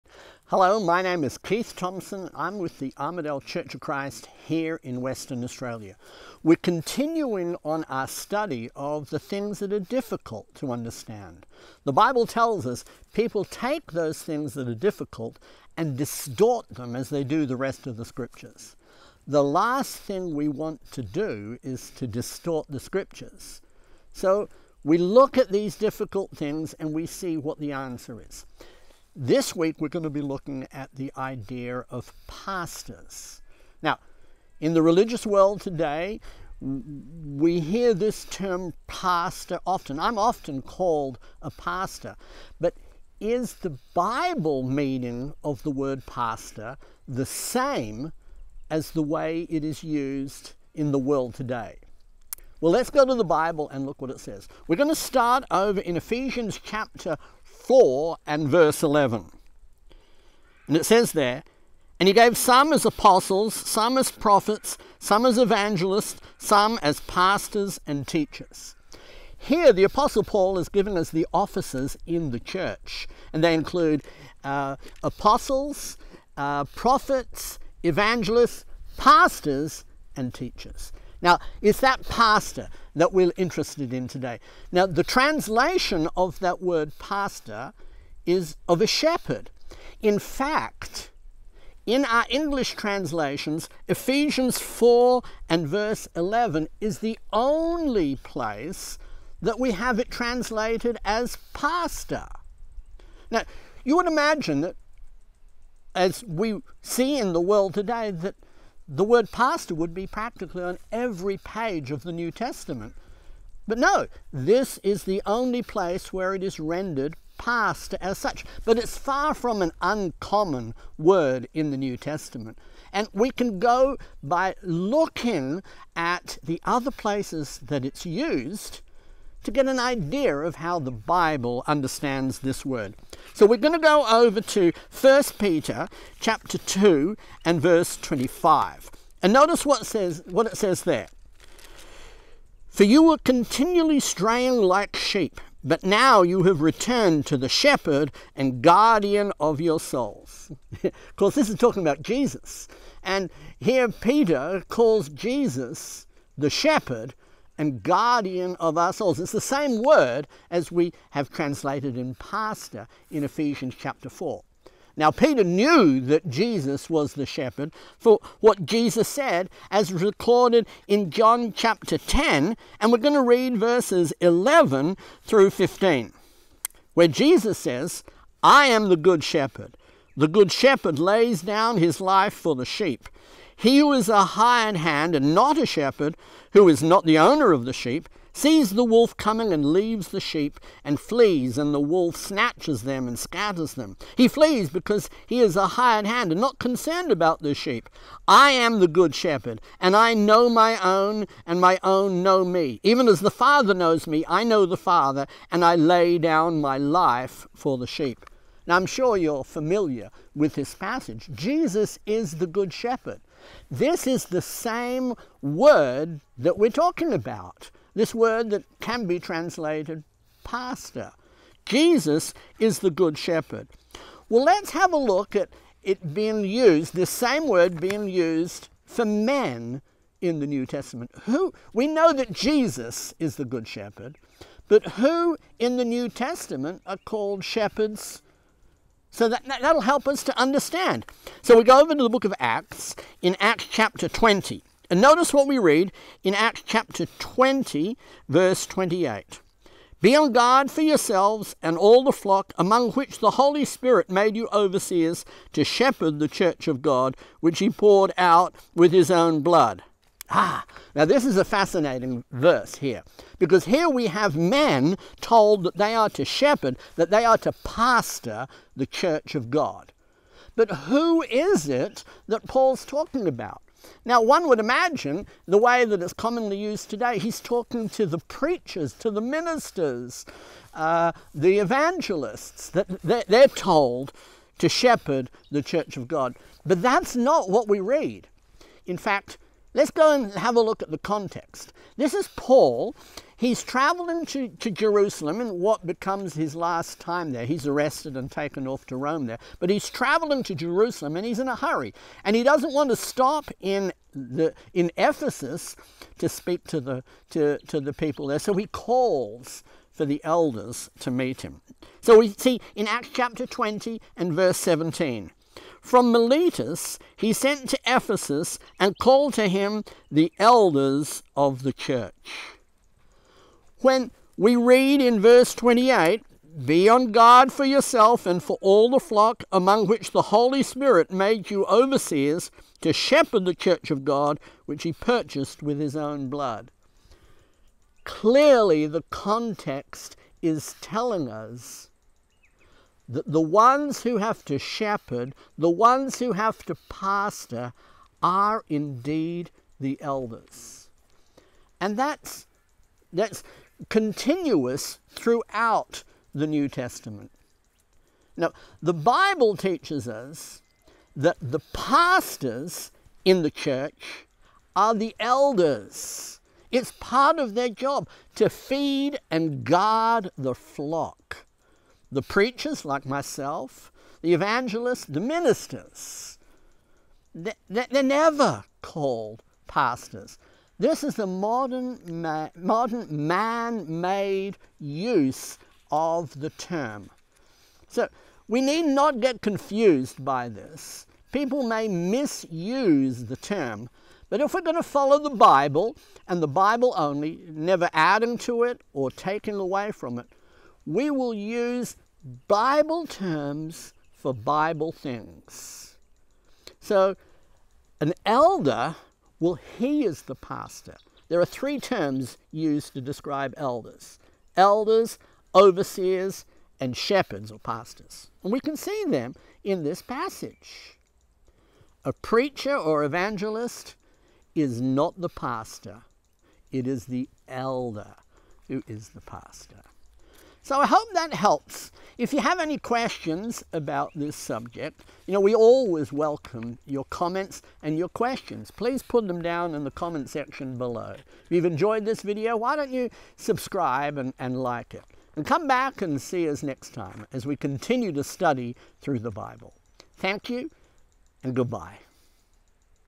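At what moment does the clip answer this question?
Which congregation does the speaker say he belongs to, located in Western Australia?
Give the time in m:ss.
0:02.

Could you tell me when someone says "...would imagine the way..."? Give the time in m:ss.
4:34.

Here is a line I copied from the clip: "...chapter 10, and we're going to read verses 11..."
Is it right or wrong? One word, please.
right.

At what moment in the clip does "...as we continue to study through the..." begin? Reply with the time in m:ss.
7:27.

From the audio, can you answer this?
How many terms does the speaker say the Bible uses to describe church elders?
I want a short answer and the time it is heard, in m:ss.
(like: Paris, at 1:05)
3, at 6:51.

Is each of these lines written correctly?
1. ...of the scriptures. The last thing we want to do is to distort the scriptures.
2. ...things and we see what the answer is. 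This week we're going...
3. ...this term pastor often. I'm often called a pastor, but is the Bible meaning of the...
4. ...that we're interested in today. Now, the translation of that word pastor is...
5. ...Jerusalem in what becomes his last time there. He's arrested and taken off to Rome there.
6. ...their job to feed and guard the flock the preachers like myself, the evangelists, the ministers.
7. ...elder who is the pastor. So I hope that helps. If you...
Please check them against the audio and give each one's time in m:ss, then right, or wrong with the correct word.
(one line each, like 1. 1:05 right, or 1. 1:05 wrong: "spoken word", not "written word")
1. 0:17 right
2. 0:26 right
3. 0:37 right
4. 1:22 right
5. 4:54 right
6. 6:07 right
7. 7:07 right.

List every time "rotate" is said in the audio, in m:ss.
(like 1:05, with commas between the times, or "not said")
not said.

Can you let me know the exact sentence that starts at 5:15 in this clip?
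From Miletus he sent to Ephesus and called to him the elders of the church.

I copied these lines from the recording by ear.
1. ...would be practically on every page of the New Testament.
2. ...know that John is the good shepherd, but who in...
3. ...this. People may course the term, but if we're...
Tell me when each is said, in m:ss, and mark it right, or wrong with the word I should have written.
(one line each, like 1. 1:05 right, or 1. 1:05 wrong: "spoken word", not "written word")
1. 1:49 right
2. 3:51 wrong: "Jesus", not "John"
3. 6:30 wrong: "misuse", not "course".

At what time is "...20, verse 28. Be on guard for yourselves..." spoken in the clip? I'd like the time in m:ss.
4:07.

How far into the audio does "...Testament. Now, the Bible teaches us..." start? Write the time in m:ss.
5:56.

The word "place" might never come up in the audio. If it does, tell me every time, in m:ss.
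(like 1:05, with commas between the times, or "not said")
1:38, 1:55, 2:06.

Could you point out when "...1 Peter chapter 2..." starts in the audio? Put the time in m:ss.
2:15.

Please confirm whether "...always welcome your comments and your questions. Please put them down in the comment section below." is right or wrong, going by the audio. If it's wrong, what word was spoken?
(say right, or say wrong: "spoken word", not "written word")
right.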